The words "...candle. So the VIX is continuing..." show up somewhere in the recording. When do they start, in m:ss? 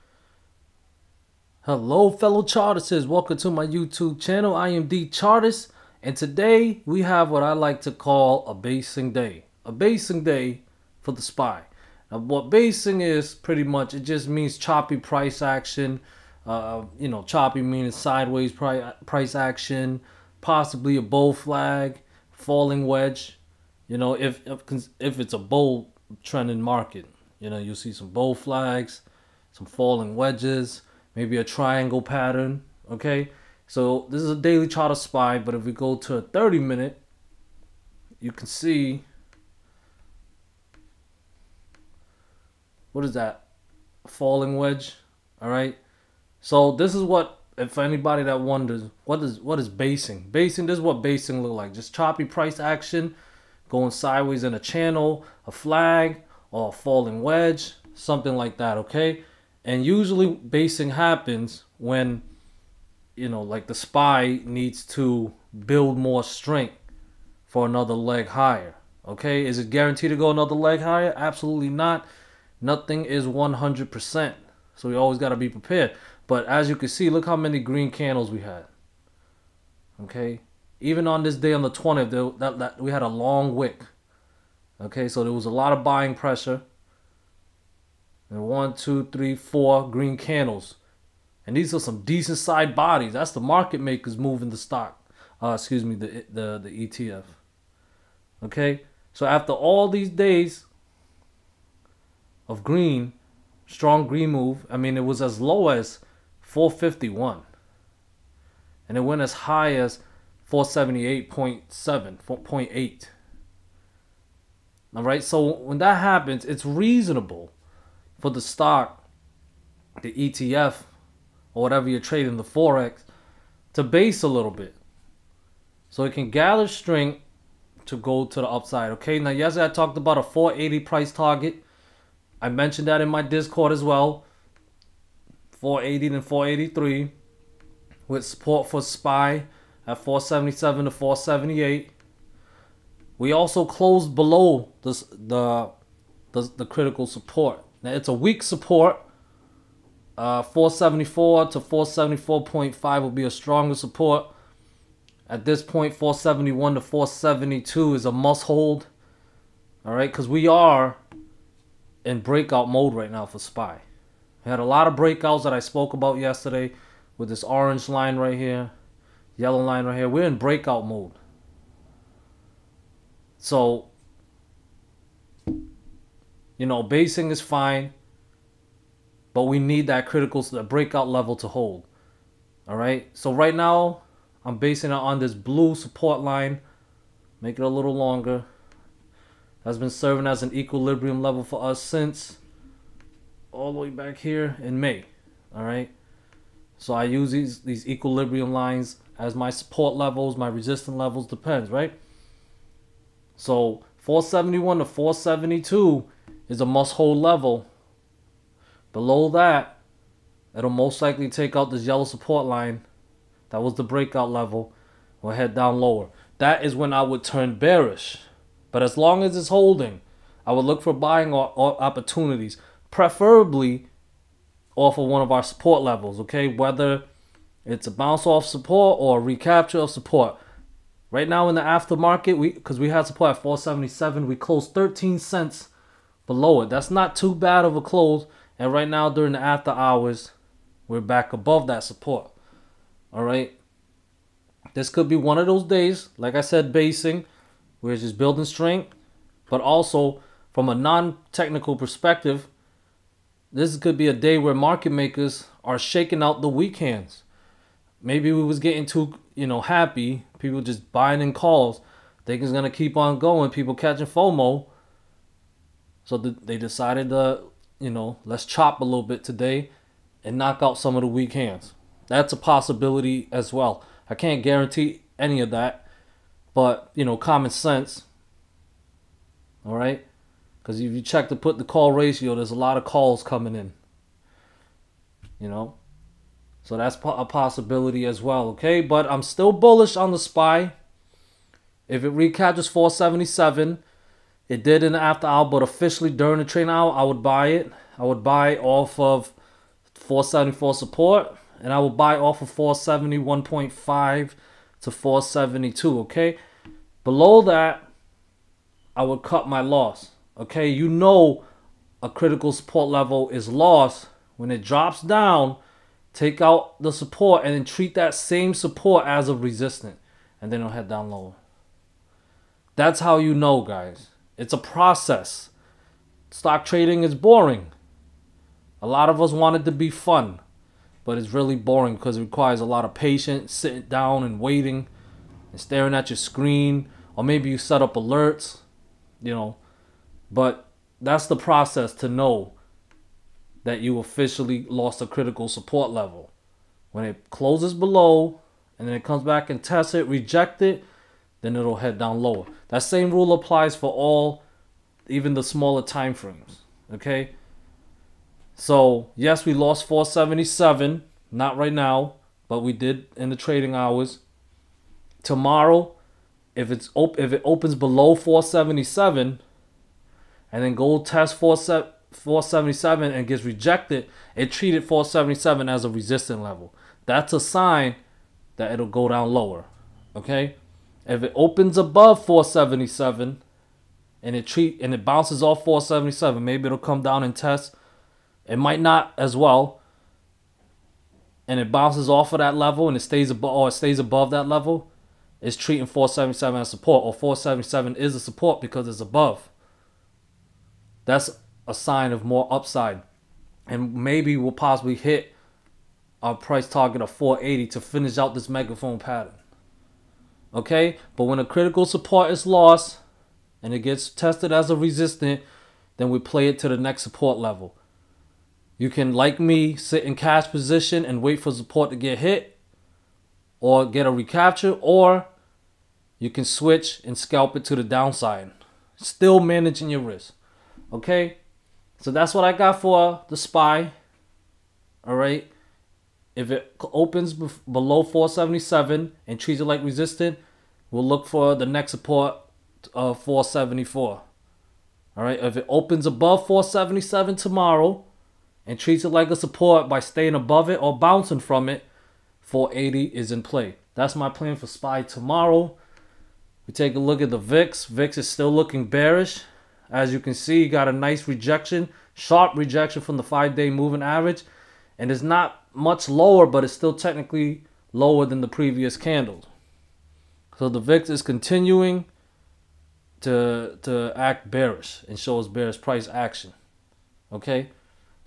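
7:48.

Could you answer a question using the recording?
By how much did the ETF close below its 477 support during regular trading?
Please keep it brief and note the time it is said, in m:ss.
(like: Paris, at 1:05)
13 cents, at 3:54.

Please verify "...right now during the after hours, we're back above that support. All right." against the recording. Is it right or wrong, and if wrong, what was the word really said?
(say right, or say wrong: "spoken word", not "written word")
right.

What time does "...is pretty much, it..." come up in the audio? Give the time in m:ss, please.
0:13.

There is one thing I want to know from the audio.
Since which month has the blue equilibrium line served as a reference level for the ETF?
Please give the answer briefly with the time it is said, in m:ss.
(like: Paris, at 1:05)
May, at 3:14.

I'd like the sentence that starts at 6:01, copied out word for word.
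Not right now, but we did in the trading hours.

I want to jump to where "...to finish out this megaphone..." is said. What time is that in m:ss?
6:47.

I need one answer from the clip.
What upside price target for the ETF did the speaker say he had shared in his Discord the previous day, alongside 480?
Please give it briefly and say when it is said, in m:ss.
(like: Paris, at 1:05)
483, at 2:16.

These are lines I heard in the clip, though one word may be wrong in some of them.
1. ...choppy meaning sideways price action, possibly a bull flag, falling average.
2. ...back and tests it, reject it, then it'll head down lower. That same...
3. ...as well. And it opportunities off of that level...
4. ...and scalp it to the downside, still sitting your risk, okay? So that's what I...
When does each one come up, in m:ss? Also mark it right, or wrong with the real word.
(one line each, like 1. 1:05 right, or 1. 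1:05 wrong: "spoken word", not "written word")
1. 0:17 wrong: "wedge", not "average"
2. 5:49 right
3. 6:29 wrong: "bounces", not "opportunities"
4. 7:07 wrong: "managing", not "sitting".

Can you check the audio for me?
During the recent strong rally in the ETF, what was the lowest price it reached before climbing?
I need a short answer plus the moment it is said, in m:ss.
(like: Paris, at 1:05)
451, at 1:46.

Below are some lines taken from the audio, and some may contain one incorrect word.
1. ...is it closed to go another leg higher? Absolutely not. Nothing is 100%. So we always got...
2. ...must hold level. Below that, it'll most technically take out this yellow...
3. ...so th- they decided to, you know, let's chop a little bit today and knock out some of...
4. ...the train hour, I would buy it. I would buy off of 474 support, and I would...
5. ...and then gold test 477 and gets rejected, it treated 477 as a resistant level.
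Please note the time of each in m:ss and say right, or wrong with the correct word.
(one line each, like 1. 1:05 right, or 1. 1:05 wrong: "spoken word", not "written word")
1. 1:09 wrong: "guaranteed", not "closed"
2. 3:26 wrong: "likely", not "technically"
3. 4:26 right
4. 4:56 right
5. 6:10 right.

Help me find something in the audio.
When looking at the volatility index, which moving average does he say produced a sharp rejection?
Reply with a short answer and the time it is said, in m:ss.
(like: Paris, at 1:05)
Five-day moving average, at 7:43.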